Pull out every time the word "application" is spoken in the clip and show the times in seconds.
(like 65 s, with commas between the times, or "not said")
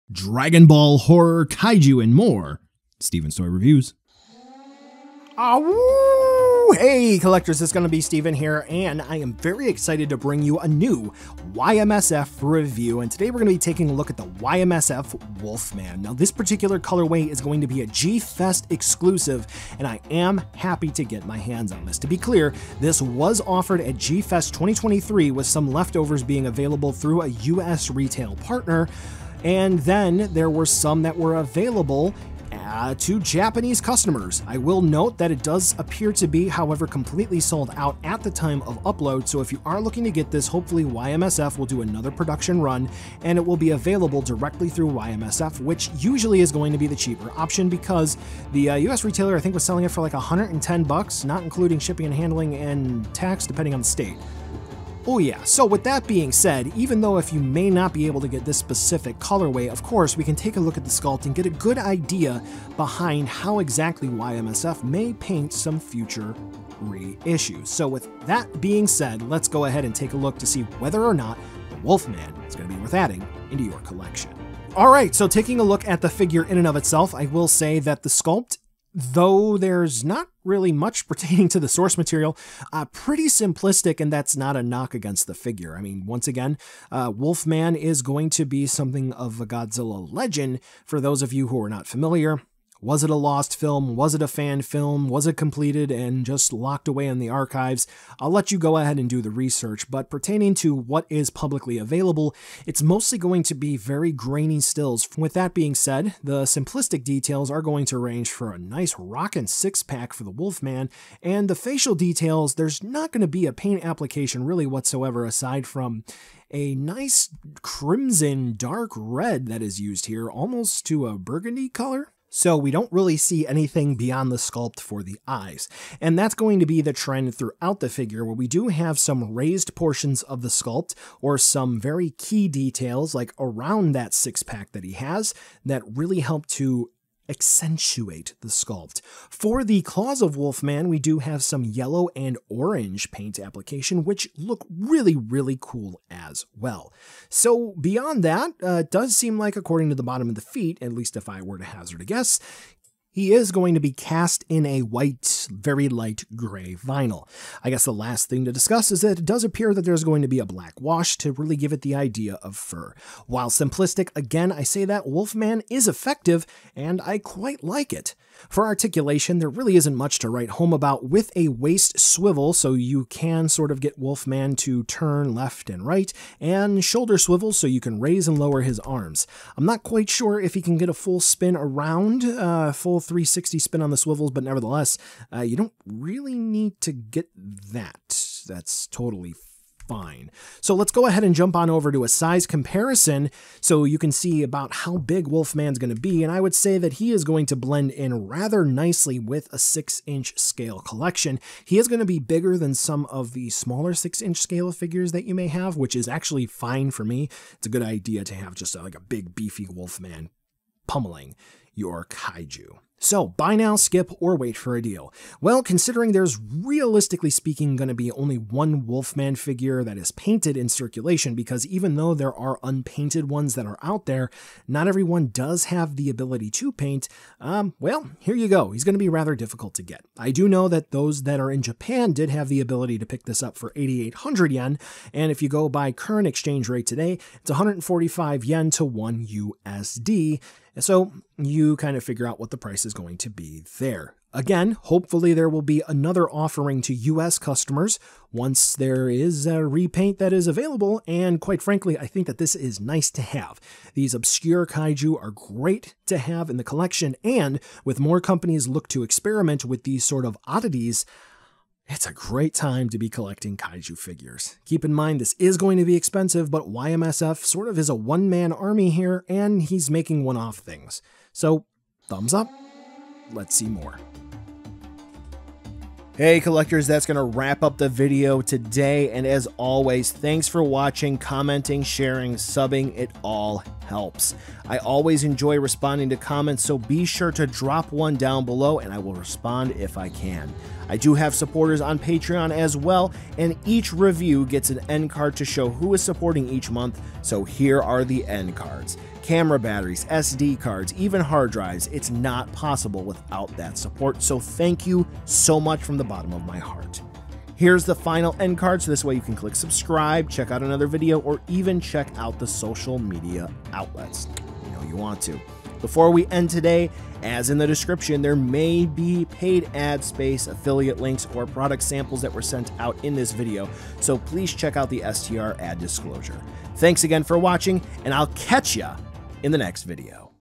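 113 s, 143 s.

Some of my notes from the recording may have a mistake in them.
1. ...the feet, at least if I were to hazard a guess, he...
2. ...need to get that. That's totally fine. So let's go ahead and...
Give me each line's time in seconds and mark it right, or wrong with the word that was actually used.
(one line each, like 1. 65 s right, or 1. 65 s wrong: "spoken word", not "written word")
1. 150 s right
2. 186 s right.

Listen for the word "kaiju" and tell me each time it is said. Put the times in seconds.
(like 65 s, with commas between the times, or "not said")
1 s, 212 s, 254 s, 263 s.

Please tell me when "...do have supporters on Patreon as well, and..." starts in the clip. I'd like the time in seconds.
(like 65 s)
290 s.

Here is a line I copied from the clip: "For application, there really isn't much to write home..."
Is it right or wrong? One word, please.
wrong.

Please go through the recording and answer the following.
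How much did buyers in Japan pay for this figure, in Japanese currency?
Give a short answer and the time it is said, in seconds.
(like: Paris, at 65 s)
8,800 yen, at 233 s.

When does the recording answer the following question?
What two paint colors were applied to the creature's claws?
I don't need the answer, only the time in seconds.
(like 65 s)
141 s.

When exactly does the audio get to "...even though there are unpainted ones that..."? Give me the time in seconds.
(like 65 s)
221 s.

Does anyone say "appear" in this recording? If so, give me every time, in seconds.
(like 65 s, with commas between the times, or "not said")
35 s, 159 s.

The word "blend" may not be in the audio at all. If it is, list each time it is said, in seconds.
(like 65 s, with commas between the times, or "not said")
197 s.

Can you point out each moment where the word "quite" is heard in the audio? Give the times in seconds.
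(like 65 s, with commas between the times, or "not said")
167 s, 179 s, 251 s.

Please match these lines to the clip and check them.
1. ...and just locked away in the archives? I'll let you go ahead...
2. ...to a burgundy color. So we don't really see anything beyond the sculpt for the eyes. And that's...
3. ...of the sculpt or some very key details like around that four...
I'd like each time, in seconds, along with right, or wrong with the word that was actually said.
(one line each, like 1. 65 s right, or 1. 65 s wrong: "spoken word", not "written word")
1. 95 s right
2. 120 s right
3. 130 s wrong: "six", not "four".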